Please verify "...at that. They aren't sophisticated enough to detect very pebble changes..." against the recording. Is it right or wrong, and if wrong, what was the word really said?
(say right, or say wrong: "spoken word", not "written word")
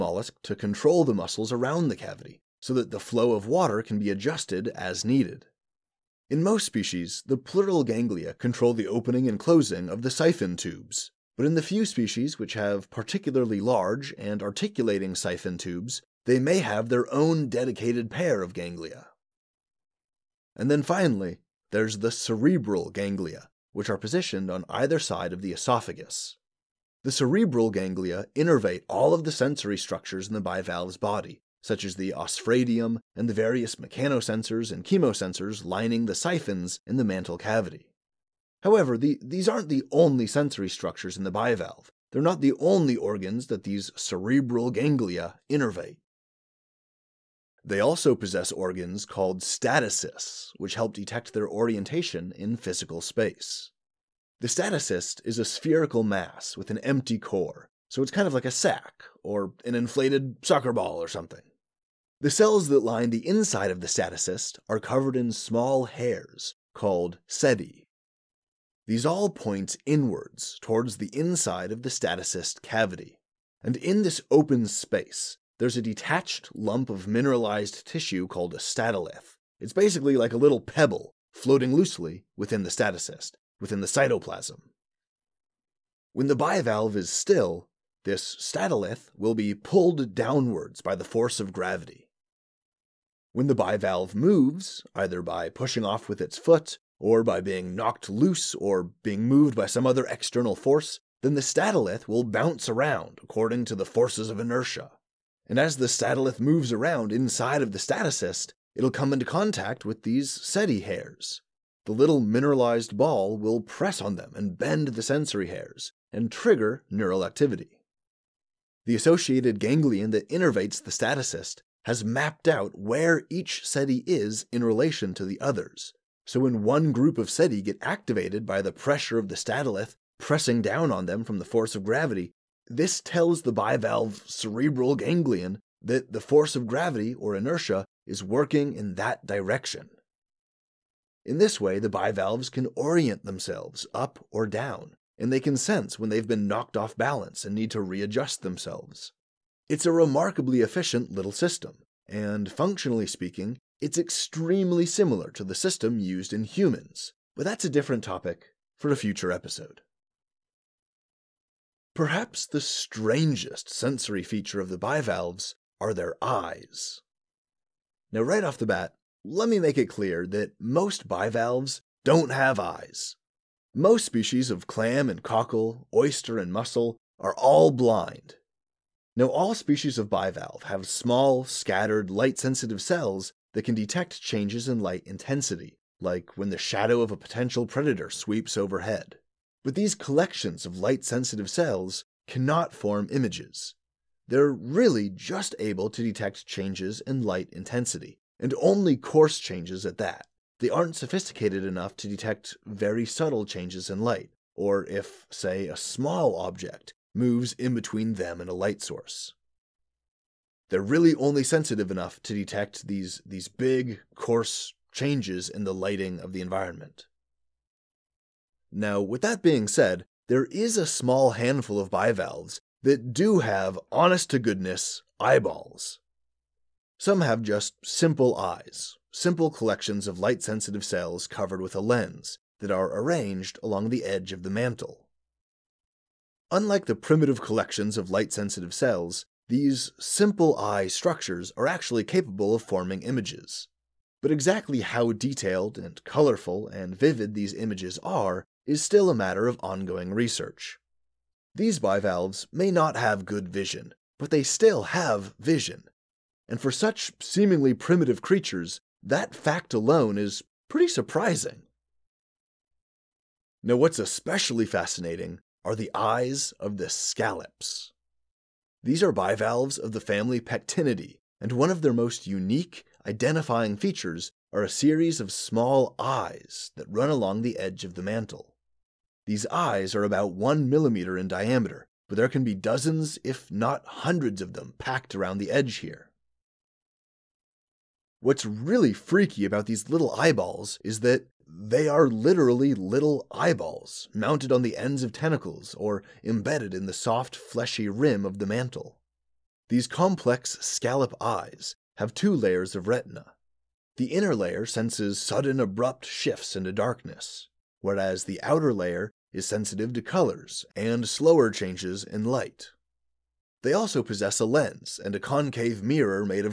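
wrong: "subtle", not "pebble".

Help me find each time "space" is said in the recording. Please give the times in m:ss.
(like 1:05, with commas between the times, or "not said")
0:52, 1:14.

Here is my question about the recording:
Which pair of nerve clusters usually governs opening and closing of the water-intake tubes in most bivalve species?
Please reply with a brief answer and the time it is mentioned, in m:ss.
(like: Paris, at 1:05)
pleural ganglia, at 0:07.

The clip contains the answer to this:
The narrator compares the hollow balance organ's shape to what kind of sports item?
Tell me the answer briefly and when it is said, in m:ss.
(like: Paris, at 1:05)
inflated soccer ball, at 0:59.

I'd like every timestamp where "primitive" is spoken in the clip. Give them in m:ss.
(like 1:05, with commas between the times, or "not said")
3:56, 4:17.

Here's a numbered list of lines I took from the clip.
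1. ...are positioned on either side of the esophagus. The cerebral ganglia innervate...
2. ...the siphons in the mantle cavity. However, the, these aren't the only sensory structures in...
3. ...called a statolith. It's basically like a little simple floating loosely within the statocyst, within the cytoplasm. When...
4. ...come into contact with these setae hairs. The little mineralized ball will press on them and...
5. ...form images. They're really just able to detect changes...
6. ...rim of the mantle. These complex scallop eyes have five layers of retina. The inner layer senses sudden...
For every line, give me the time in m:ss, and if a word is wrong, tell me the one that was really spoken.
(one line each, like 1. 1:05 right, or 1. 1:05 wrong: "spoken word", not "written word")
1. 0:23 right
2. 0:36 right
3. 1:18 wrong: "pebble", not "simple"
4. 1:48 right
5. 3:12 right
6. 4:57 wrong: "two", not "five".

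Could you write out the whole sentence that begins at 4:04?
But exactly how detailed and colorful and vivid these images are is still a matter of ongoing research.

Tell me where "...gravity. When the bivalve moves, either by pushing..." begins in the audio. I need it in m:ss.
1:31.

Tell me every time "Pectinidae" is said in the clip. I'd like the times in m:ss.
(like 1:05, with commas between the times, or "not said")
4:30.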